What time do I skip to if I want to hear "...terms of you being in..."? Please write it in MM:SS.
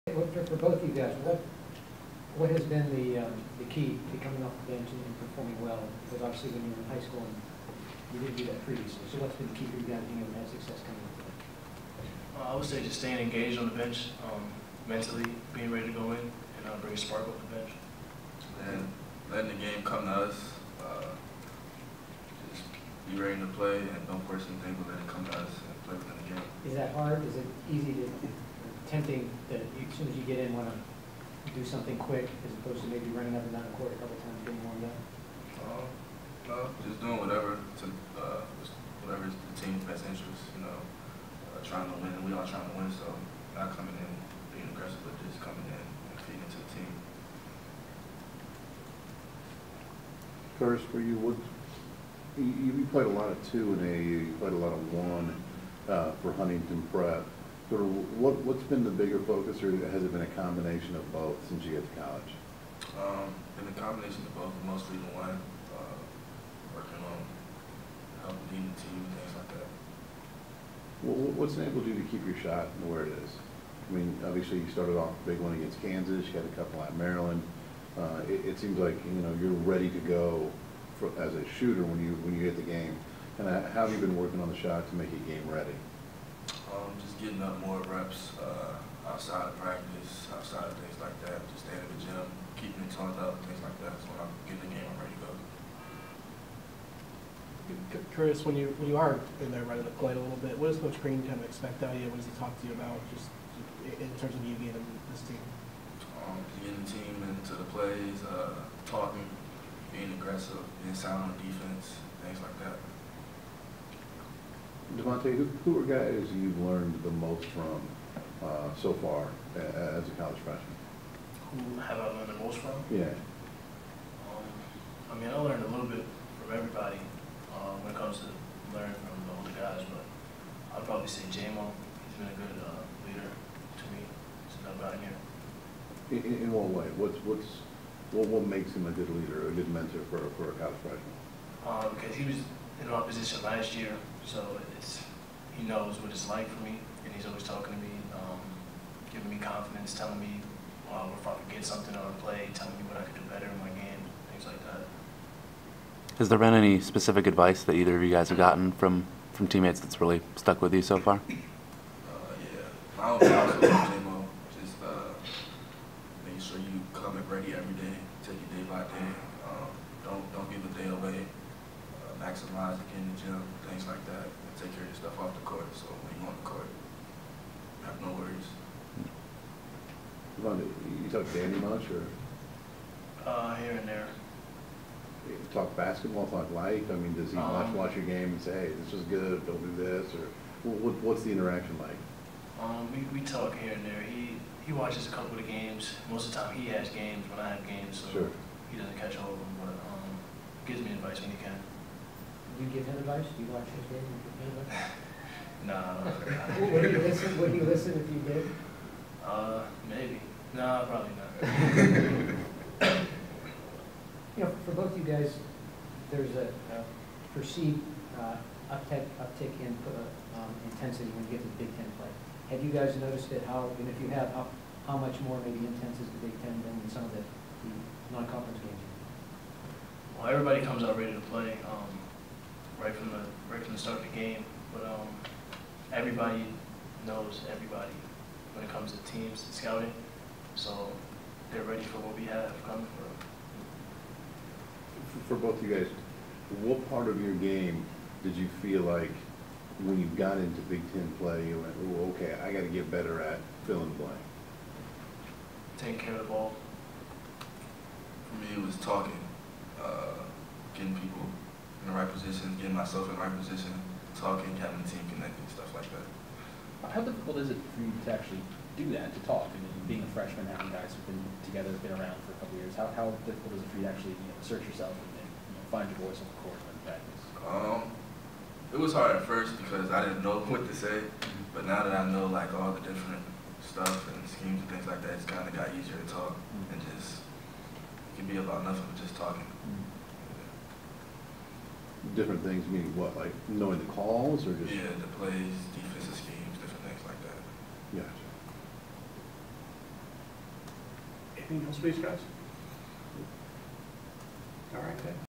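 01:44.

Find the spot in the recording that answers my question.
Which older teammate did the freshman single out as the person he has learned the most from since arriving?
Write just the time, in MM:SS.
02:11.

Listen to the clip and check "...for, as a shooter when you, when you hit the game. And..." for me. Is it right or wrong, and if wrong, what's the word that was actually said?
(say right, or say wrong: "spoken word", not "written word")
right.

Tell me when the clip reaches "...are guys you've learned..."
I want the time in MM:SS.
01:55.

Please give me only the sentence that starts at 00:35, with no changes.
Um, no, just doing whatever to uh, whatever is the team's best interest.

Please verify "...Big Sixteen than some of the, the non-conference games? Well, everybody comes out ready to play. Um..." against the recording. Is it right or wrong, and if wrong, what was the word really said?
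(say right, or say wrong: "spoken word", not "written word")
wrong: "Ten", not "Sixteen".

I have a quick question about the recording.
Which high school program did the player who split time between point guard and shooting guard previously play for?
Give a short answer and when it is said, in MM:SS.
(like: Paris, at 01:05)
Huntington Prep, at 00:56.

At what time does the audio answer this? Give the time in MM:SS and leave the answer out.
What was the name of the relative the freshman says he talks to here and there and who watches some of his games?
03:01.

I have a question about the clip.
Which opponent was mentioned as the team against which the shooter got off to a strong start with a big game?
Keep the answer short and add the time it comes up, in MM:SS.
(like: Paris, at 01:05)
Kansas, at 01:15.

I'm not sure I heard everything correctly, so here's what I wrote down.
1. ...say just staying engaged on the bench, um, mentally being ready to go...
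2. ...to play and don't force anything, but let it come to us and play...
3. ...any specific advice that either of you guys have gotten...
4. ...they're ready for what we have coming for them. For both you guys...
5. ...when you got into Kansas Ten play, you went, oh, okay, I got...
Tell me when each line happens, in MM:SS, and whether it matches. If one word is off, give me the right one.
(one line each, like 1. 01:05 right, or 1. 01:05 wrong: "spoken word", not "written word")
1. 00:12 right
2. 00:23 right
3. 02:36 right
4. 04:01 right
5. 04:09 wrong: "Big", not "Kansas".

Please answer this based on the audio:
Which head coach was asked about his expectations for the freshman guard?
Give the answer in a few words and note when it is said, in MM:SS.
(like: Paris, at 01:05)
Coach Crean, at 01:40.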